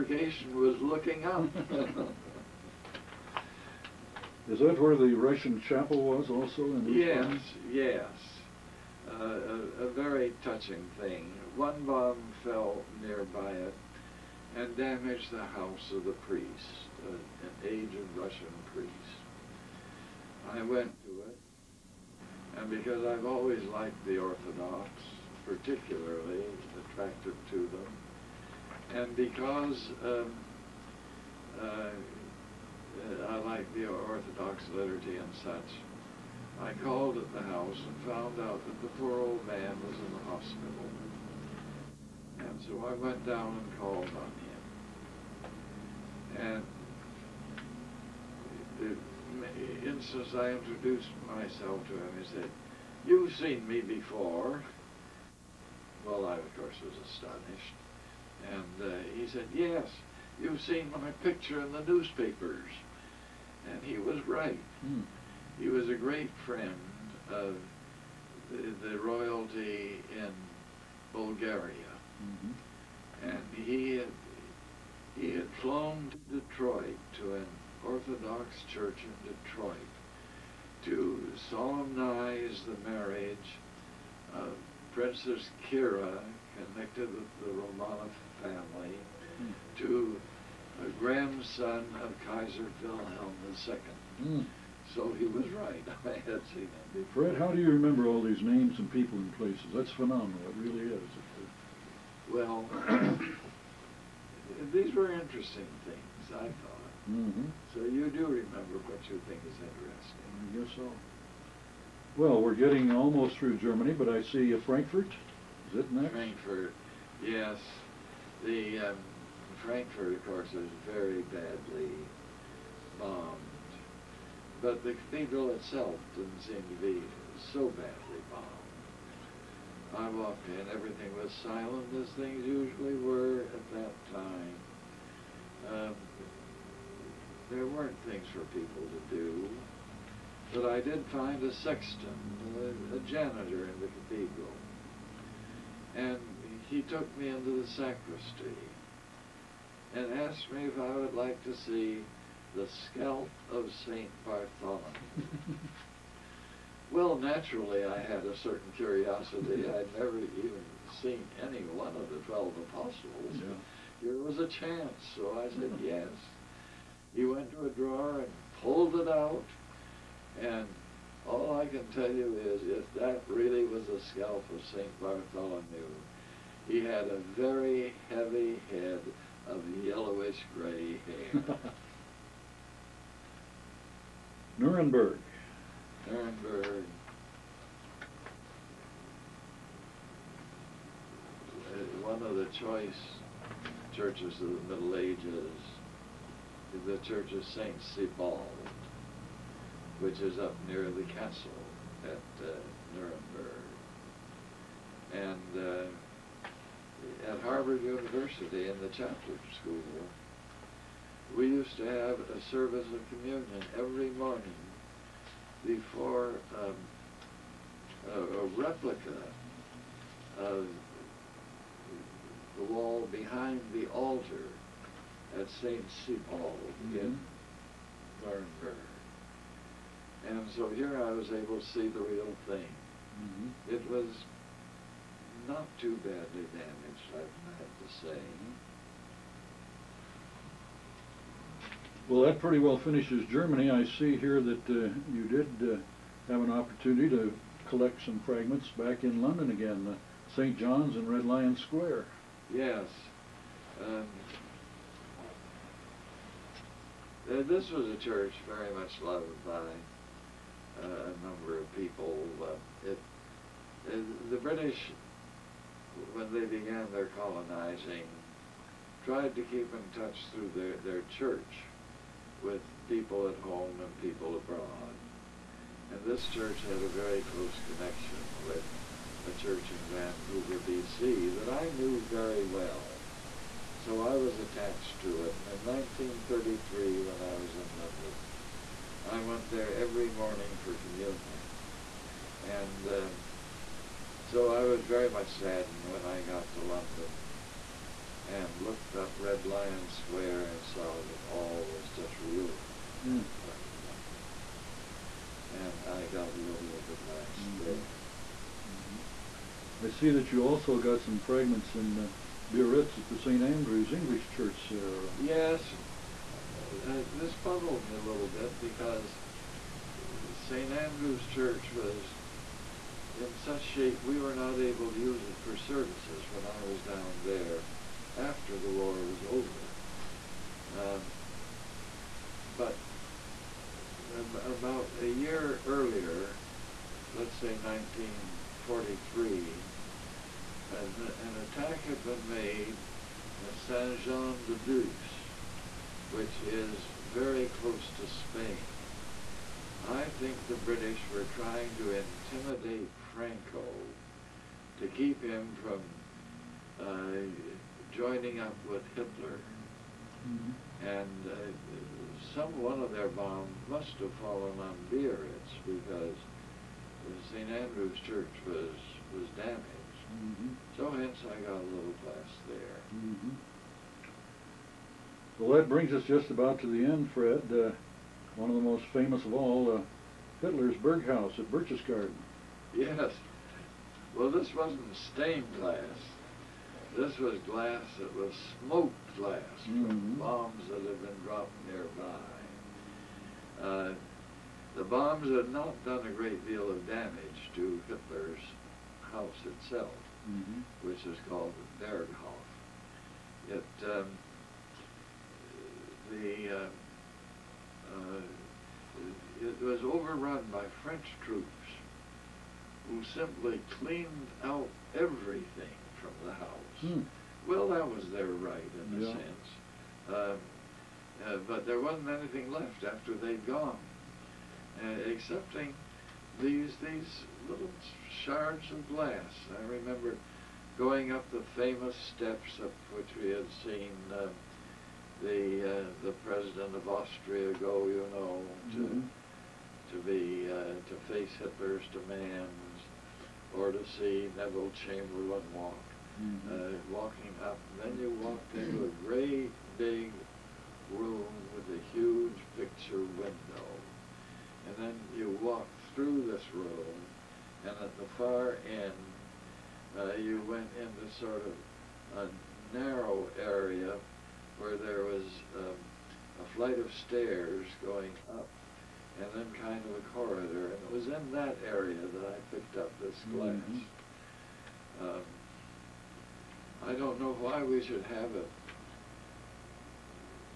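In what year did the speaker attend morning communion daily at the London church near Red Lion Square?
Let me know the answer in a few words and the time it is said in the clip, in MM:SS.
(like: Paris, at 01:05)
1933, at 04:46.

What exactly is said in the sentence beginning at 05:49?
I think the British were trying to intimidate Franco to keep him from uh, joining up with Hitler.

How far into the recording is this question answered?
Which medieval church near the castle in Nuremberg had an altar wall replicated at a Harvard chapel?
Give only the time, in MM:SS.
03:17.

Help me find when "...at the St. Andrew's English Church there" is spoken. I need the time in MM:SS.
05:12.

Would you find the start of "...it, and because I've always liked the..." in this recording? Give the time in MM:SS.
00:21.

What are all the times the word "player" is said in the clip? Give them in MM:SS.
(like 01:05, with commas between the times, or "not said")
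not said.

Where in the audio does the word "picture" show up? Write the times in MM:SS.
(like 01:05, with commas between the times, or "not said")
01:01, 07:32.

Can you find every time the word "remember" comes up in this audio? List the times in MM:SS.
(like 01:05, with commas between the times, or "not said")
01:37, 01:48, 07:09.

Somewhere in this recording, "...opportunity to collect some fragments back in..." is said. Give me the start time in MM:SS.
04:06.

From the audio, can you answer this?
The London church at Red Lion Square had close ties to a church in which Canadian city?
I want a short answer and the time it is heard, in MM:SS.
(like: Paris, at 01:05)
Vancouver, at 04:39.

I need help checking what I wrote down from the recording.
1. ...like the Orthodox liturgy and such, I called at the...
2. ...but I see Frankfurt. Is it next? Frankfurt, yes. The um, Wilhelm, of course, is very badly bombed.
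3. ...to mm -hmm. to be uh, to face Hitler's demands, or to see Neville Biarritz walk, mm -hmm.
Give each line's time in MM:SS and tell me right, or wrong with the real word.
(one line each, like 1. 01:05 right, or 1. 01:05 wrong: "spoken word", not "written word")
1. 00:33 right
2. 01:53 wrong: "Frankfurt", not "Wilhelm"
3. 07:18 wrong: "Chamberlain", not "Biarritz".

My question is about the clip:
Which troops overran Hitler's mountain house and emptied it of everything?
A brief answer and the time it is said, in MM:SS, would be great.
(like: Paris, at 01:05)
French troops, at 06:50.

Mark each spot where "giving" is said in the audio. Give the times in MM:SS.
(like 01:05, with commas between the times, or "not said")
not said.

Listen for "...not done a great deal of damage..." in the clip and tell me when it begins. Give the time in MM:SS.
06:35.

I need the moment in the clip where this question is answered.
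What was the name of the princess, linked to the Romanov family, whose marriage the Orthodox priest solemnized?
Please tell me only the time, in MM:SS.
01:24.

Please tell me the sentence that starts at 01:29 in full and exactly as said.
to a grandson of Kaiser Wilhelm II.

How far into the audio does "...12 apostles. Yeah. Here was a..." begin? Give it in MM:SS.
02:42.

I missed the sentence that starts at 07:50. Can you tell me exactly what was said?
And it was in that area that I picked up this mm-hmm.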